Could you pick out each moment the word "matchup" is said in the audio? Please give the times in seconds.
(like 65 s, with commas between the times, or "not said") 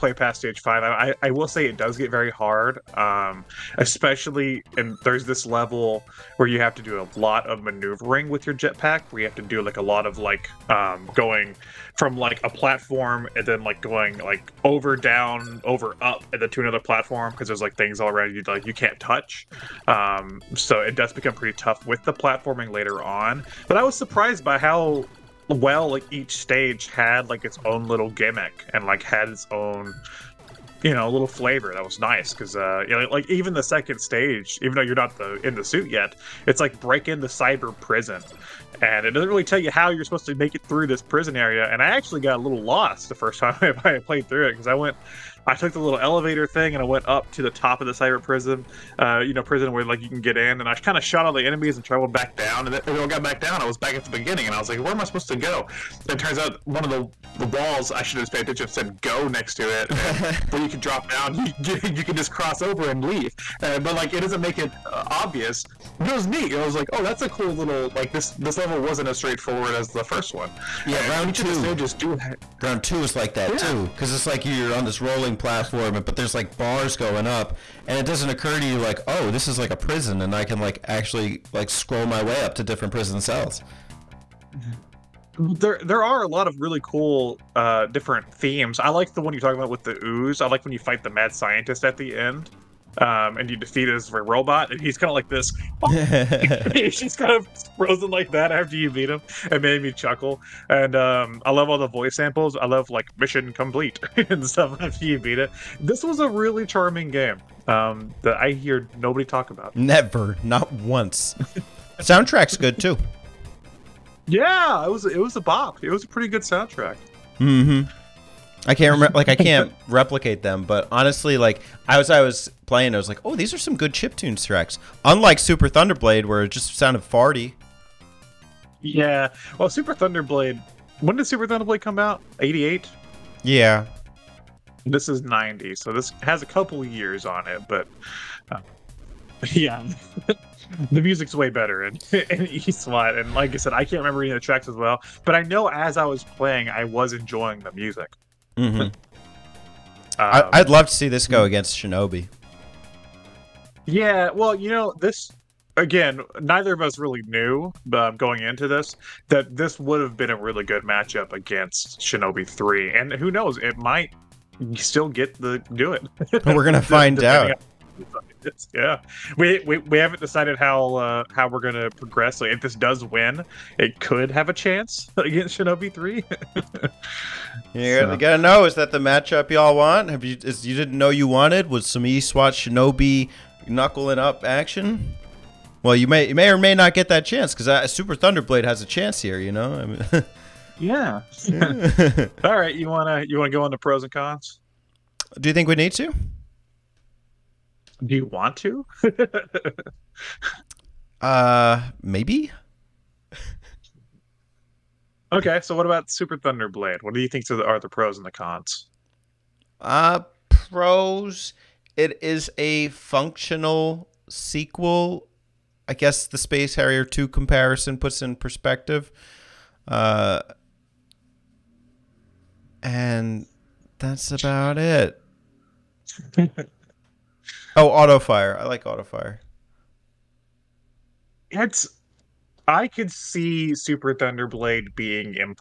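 160 s, 178 s.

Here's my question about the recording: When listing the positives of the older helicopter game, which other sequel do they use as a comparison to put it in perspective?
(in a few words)
Space Harrier 2.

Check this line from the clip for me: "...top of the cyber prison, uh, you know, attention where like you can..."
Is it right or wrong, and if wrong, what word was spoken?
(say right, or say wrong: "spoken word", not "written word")
wrong: "prison", not "attention".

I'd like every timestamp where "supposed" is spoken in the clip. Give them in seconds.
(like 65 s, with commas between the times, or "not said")
40 s, 55 s.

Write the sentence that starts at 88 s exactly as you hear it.
I like the one you're talking about with the ooze.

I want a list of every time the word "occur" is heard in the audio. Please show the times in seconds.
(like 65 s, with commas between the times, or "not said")
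78 s.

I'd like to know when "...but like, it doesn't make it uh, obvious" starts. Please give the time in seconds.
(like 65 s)
63 s.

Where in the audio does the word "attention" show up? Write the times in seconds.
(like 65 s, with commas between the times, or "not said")
58 s.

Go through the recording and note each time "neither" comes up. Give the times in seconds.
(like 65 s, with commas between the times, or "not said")
156 s.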